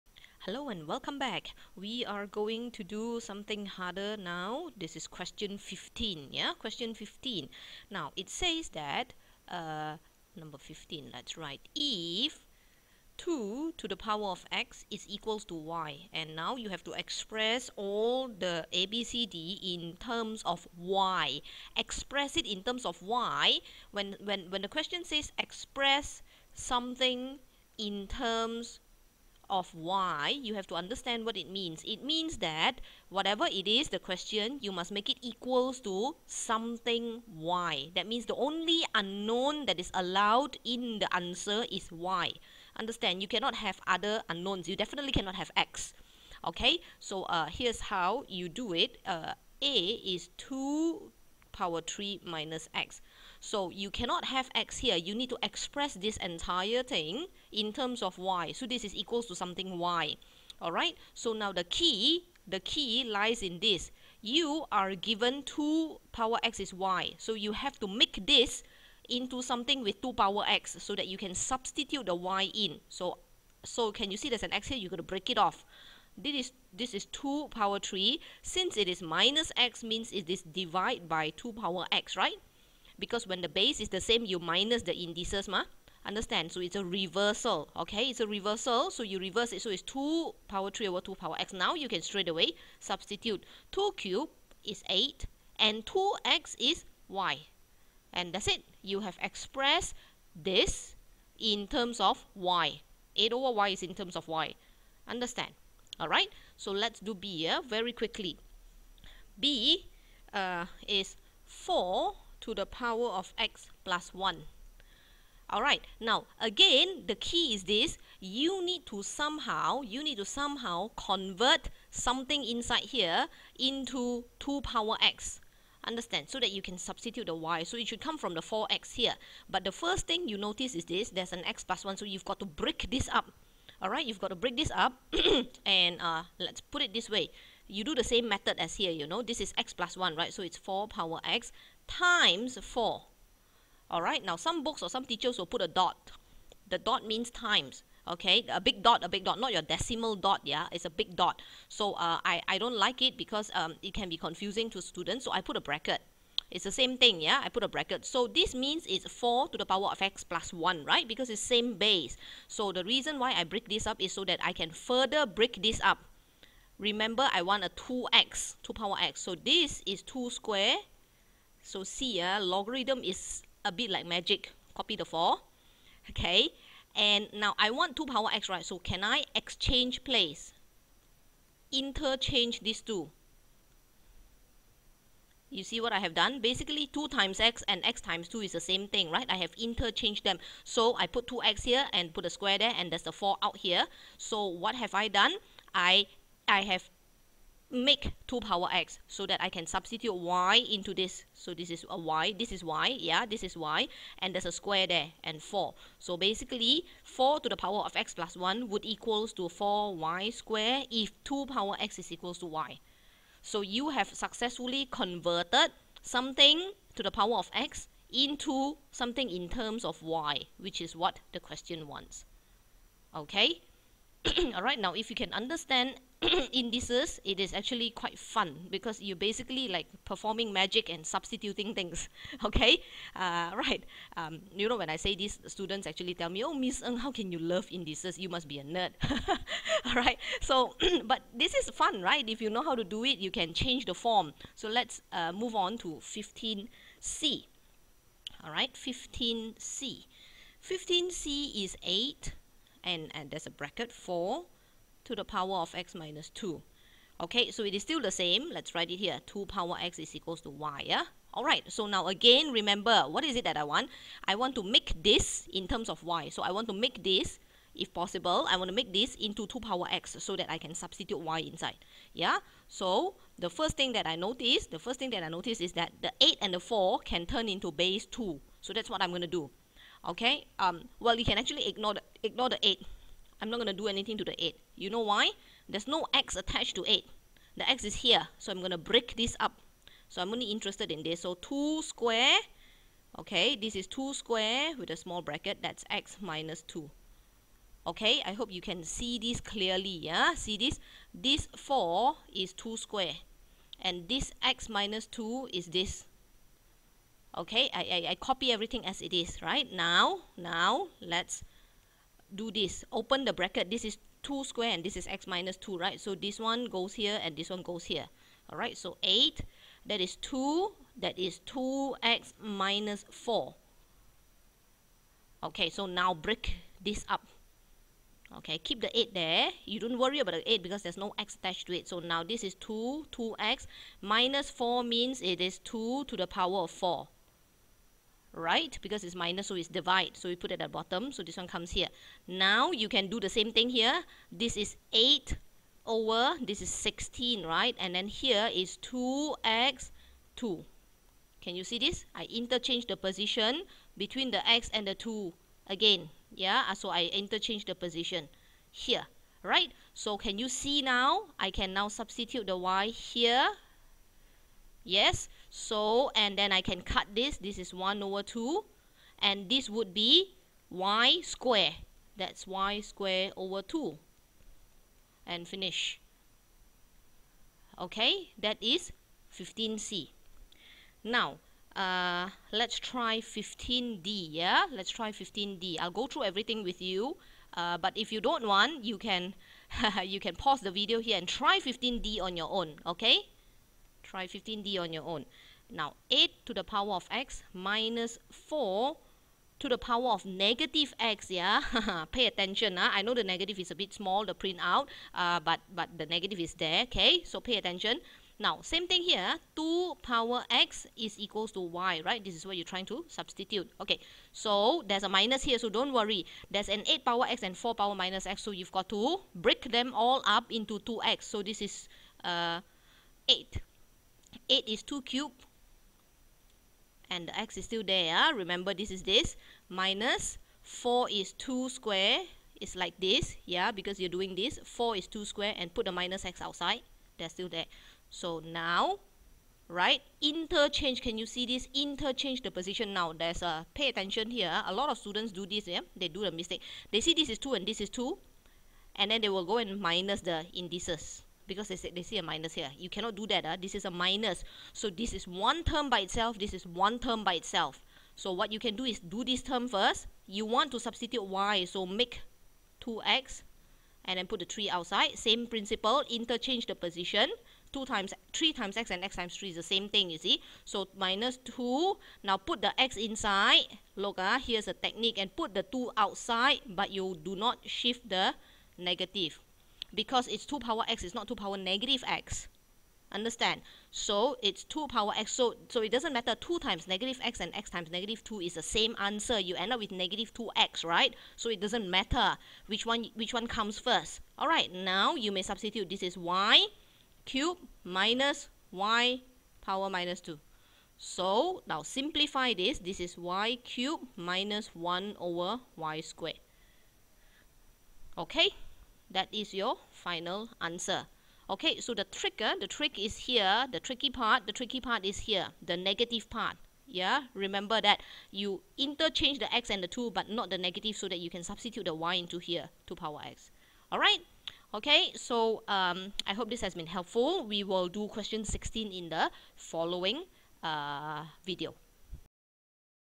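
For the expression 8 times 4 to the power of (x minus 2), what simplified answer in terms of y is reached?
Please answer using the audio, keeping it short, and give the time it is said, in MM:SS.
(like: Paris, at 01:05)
y square over 2, at 06:12.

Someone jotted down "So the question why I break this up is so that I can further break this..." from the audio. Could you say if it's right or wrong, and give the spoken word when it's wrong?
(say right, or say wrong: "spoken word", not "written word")
wrong: "reason", not "question".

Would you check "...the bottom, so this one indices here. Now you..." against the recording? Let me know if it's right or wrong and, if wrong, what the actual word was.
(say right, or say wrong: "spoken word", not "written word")
wrong: "comes", not "indices".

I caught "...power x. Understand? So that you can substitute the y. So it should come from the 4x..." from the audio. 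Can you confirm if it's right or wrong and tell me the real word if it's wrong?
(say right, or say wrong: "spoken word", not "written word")
right.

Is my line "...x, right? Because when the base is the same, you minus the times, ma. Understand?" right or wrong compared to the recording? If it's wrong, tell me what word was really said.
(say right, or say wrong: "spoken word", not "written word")
wrong: "indices", not "times".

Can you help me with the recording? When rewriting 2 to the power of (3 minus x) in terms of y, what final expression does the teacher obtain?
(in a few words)
8 over y.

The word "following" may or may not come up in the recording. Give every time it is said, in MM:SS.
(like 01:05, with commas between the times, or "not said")
08:49.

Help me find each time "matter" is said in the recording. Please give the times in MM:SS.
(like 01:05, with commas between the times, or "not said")
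08:06, 08:11.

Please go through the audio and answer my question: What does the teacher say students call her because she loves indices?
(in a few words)
a nerd.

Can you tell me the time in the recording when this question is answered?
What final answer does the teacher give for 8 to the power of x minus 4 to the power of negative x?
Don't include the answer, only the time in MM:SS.
08:23.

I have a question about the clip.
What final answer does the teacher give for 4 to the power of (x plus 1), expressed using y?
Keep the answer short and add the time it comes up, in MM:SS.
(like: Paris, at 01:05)
4y square, at 03:29.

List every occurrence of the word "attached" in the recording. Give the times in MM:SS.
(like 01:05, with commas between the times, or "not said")
04:46, 05:31.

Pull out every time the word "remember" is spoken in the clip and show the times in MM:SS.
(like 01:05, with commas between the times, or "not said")
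02:46, 04:22, 07:08, 08:37.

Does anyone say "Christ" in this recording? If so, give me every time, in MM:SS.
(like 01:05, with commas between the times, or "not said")
not said.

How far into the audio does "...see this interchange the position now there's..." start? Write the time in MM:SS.
07:21.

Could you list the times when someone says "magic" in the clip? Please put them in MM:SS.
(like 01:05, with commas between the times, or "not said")
02:54, 03:50.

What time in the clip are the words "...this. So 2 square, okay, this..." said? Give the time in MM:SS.
04:51.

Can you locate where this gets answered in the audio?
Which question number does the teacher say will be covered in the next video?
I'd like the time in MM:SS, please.
08:48.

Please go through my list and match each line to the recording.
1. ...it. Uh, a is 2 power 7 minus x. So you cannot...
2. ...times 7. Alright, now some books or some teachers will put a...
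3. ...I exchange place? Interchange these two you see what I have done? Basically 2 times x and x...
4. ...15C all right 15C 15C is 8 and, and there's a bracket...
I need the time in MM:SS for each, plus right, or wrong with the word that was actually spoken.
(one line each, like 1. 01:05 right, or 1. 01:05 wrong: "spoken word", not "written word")
1. 00:48 wrong: "3", not "7"
2. 02:21 wrong: "4", not "7"
3. 02:59 right
4. 04:06 right.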